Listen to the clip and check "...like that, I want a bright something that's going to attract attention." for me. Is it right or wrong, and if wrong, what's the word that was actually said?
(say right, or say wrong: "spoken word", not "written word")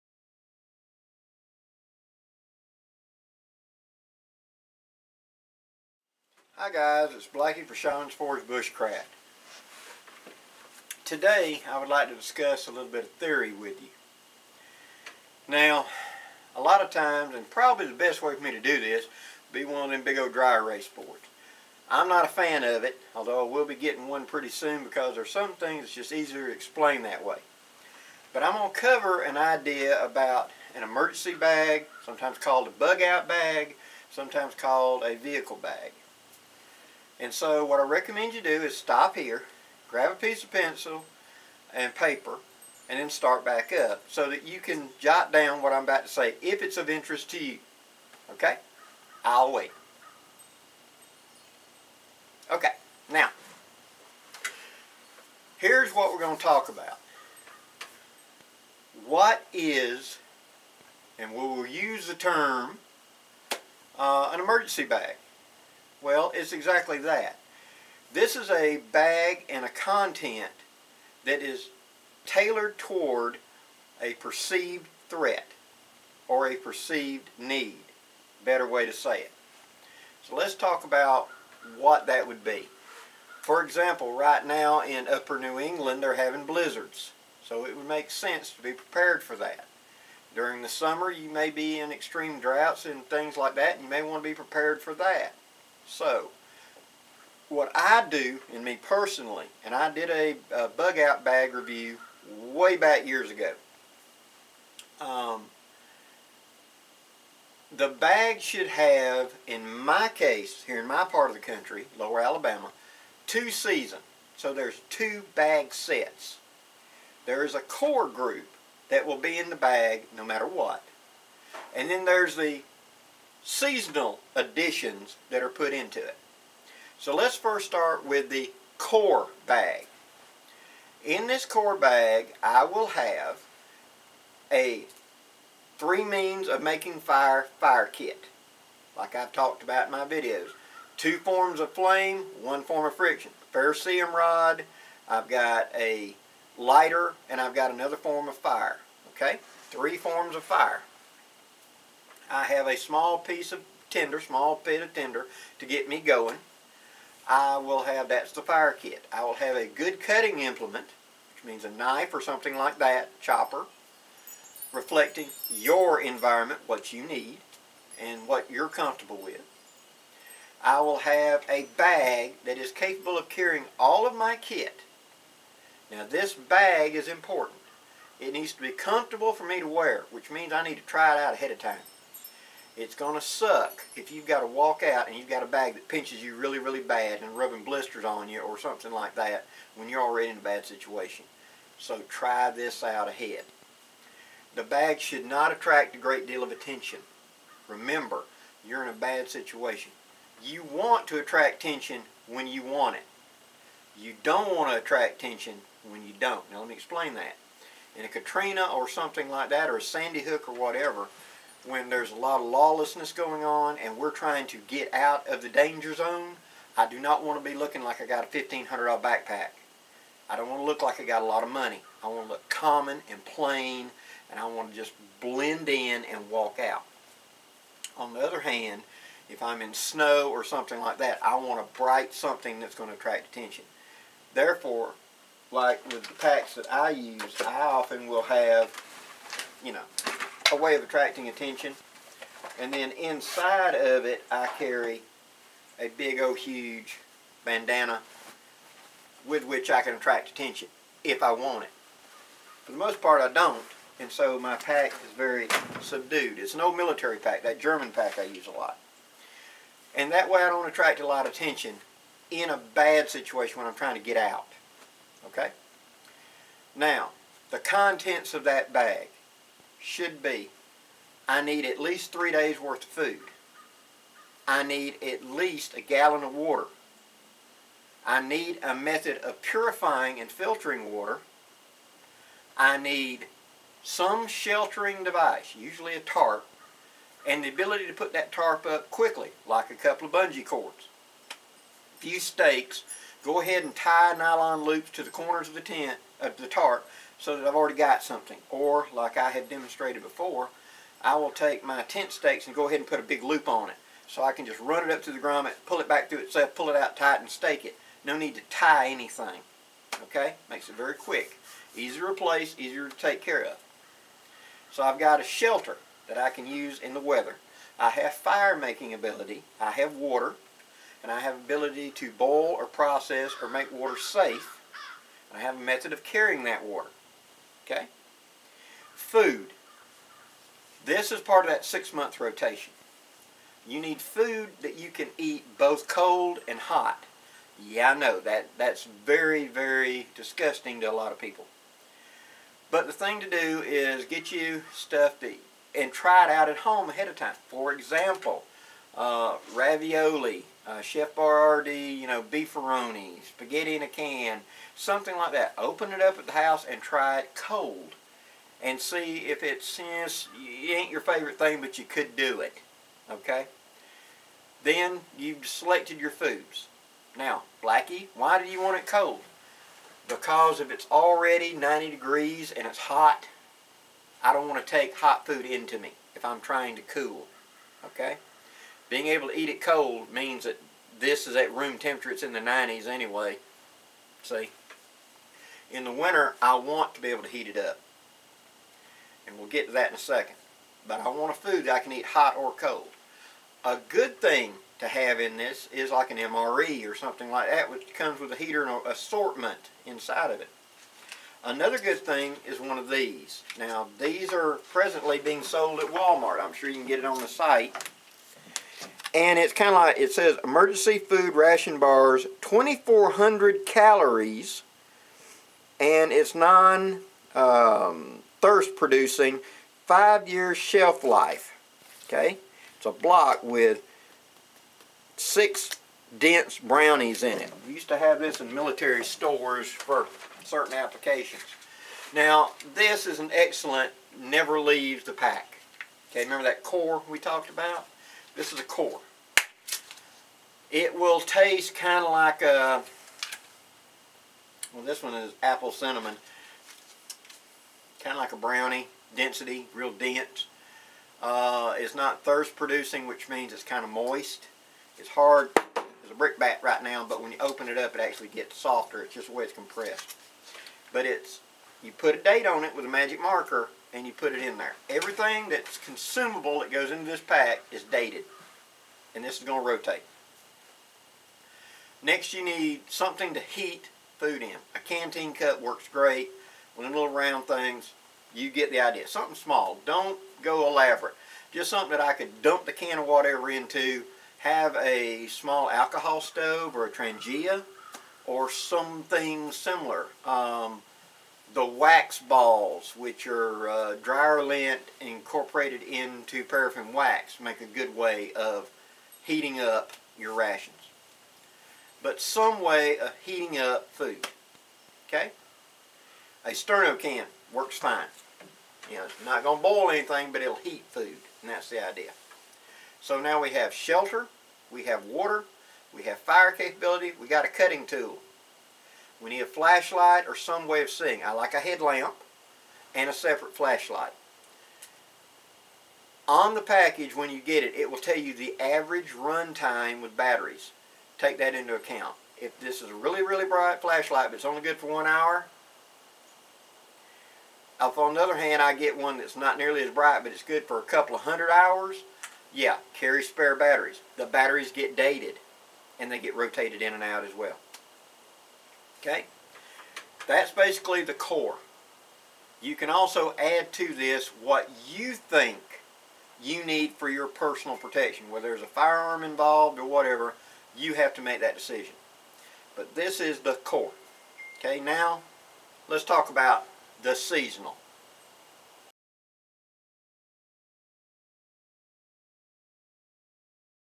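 right.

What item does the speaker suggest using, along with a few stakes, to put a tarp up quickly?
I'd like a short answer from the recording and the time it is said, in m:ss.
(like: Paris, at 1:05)
bungee cords, at 4:50.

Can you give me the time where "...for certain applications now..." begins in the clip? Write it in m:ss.
7:09.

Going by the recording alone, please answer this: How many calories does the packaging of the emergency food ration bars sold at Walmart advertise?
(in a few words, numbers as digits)
2400.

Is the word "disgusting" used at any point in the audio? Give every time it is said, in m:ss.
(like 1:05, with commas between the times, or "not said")
5:40.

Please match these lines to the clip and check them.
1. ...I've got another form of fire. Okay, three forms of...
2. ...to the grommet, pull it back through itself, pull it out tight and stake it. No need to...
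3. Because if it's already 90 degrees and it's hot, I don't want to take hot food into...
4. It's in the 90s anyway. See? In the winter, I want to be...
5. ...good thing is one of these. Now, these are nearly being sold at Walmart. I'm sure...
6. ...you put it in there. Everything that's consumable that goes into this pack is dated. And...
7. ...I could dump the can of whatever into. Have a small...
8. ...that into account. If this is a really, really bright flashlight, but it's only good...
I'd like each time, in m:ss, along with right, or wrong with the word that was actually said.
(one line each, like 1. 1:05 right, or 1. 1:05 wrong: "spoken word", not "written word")
1. 2:27 right
2. 5:05 right
3. 6:10 right
4. 6:22 right
5. 6:41 wrong: "presently", not "nearly"
6. 7:44 right
7. 8:02 right
8. 8:51 right.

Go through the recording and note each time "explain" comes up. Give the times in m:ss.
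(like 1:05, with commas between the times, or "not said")
0:26, 3:26.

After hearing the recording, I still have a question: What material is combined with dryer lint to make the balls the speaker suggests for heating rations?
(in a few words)
paraffin wax.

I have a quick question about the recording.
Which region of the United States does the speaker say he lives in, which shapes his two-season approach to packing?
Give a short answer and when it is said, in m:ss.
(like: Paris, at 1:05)
lower Alabama, at 1:51.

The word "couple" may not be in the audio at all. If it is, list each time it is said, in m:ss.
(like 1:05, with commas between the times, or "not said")
4:49, 9:00.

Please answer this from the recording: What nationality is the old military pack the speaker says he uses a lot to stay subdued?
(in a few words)
German.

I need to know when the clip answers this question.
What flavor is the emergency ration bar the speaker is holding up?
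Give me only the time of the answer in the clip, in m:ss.
7:25.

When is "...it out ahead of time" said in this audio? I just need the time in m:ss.
3:01.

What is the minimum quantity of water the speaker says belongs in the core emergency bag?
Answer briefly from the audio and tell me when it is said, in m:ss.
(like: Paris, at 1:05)
a gallon, at 4:35.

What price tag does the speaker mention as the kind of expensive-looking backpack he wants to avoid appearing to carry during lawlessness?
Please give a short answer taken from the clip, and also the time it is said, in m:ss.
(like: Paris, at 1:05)
$1,500, at 3:38.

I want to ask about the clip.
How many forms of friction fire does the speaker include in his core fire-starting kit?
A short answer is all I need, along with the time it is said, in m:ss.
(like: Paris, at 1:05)
1, at 2:22.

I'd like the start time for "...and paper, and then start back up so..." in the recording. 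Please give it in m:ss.
0:41.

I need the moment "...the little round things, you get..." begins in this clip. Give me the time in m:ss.
7:56.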